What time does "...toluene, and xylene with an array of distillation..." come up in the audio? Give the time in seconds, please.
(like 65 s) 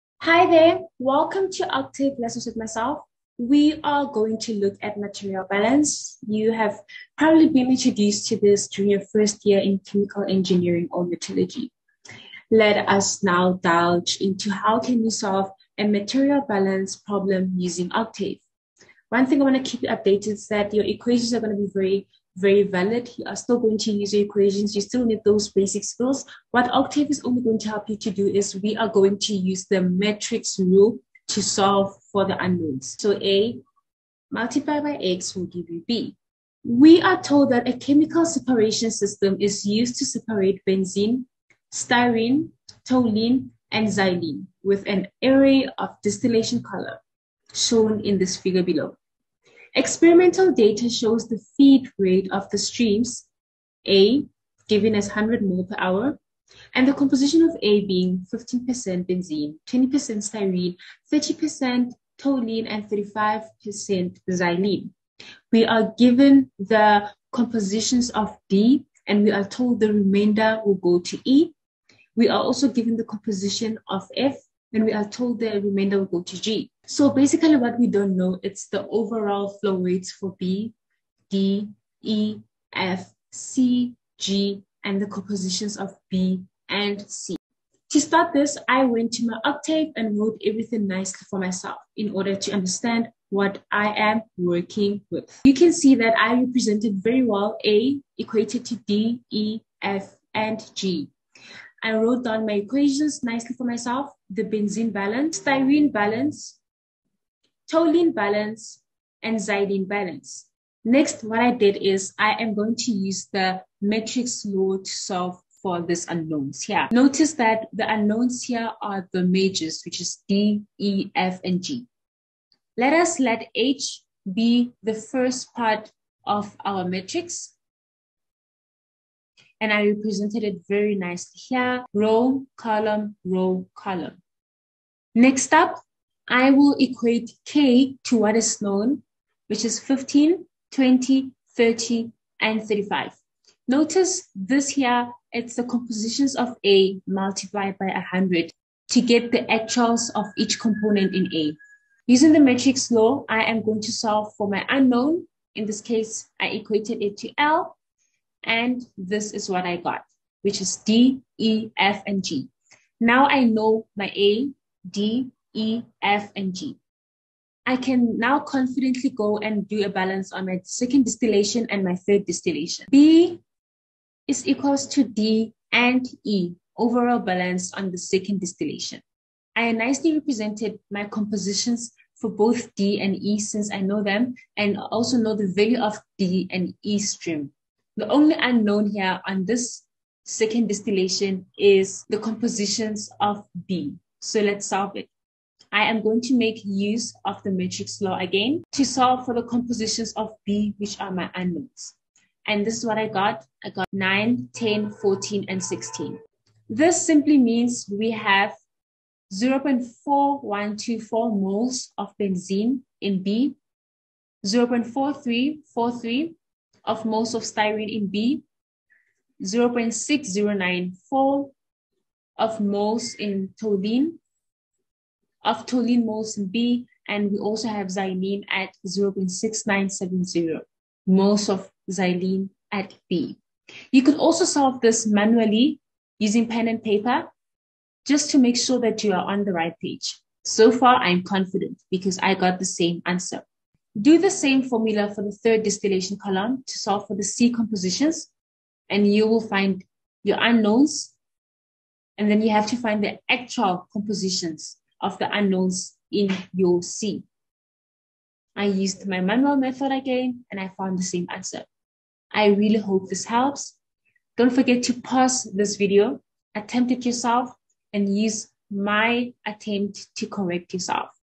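42 s.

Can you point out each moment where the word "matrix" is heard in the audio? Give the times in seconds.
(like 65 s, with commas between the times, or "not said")
29 s, 113 s, 126 s, 152 s, 197 s.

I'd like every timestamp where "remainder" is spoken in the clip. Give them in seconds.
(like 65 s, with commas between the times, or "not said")
69 s, 75 s.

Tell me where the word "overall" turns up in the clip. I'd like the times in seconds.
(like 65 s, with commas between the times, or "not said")
78 s, 176 s.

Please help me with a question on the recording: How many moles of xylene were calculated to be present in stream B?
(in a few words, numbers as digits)
0.6970.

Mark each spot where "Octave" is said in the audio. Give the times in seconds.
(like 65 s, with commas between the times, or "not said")
1 s, 17 s, 26 s, 89 s.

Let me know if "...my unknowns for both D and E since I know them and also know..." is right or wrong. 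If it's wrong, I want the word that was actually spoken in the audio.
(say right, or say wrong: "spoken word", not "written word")
wrong: "compositions", not "unknowns".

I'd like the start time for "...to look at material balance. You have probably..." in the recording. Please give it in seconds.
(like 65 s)
4 s.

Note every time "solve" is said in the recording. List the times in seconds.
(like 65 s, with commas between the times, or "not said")
15 s, 31 s, 114 s, 153 s, 194 s, 198 s, 234 s, 246 s.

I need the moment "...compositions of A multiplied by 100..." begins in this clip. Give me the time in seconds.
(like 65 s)
145 s.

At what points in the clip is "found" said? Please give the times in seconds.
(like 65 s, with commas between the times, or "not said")
260 s.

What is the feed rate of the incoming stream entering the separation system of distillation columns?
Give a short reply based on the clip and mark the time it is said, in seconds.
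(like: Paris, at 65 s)
100 mole per hour, at 55 s.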